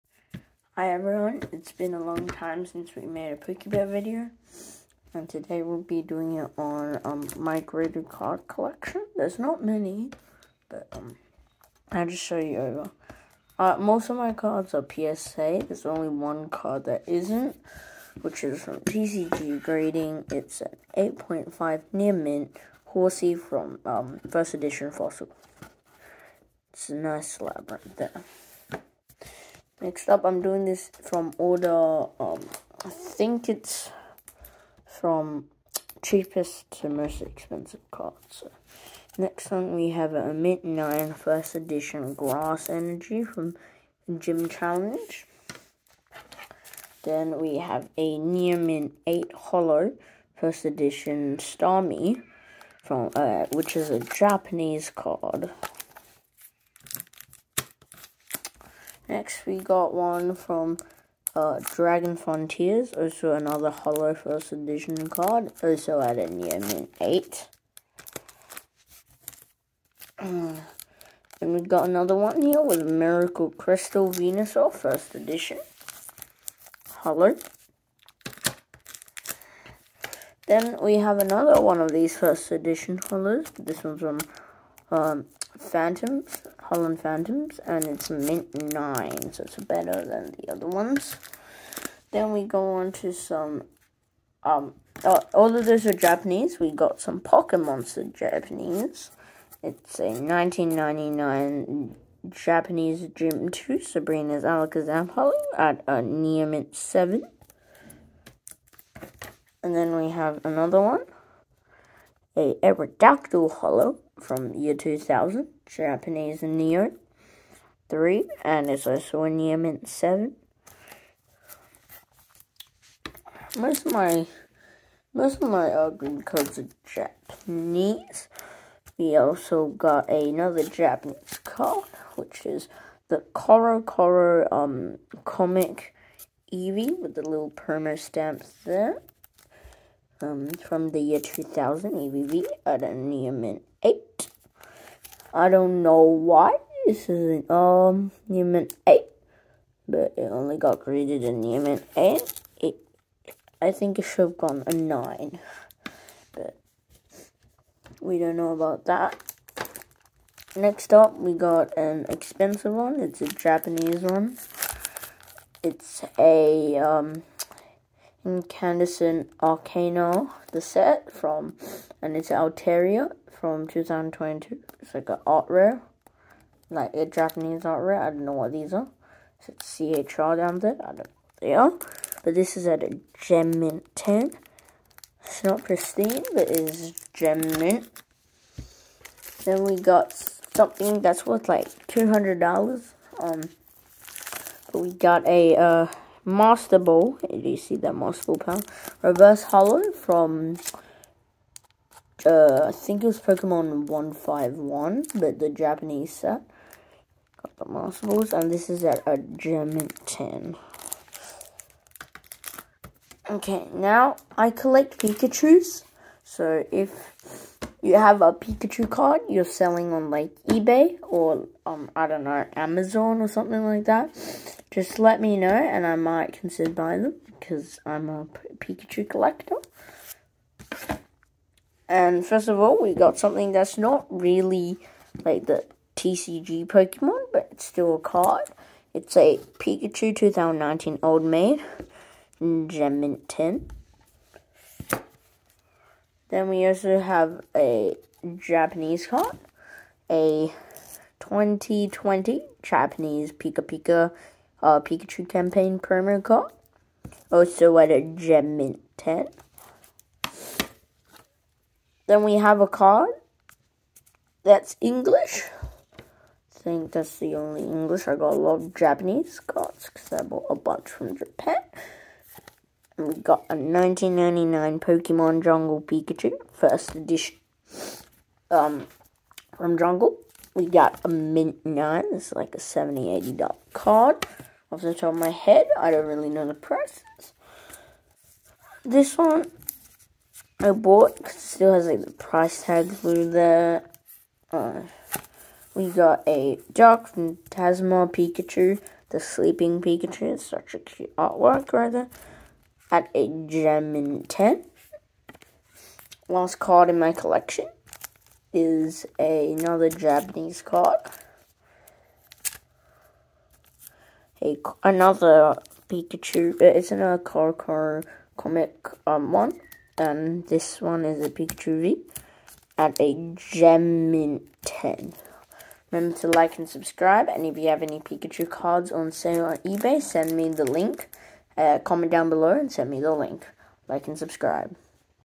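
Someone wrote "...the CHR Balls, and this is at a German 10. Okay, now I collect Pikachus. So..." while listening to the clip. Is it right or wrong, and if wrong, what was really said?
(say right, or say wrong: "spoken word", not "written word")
wrong: "Master", not "CHR".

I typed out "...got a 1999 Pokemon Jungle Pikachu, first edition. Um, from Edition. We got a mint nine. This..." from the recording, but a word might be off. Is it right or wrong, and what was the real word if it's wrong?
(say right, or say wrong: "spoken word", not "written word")
wrong: "Jungle", not "Edition".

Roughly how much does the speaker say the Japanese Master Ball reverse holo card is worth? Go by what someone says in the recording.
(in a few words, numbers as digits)
$200.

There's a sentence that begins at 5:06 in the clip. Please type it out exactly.
Last card in my collection is a, another Japanese card.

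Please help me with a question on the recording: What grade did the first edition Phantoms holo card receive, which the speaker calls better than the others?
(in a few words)
mint 9.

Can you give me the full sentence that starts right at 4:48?
This one I bought because it still has like the price tag through there.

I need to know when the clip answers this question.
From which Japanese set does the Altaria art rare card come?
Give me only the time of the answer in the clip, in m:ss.
2:48.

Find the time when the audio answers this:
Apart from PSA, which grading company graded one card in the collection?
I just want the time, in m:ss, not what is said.
0:18.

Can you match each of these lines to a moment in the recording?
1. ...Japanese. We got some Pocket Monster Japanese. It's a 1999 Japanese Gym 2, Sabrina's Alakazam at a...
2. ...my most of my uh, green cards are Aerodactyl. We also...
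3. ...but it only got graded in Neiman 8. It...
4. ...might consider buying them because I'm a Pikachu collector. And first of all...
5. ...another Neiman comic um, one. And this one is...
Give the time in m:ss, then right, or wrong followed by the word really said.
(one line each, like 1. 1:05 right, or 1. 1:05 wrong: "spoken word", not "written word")
1. 1:35 right
2. 2:03 wrong: "Japanese", not "Aerodactyl"
3. 2:29 right
4. 3:45 right
5. 5:16 wrong: "Car", not "Neiman".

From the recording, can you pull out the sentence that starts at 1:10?
and we got another one here with Miracle Crystal Venusaur First Edition.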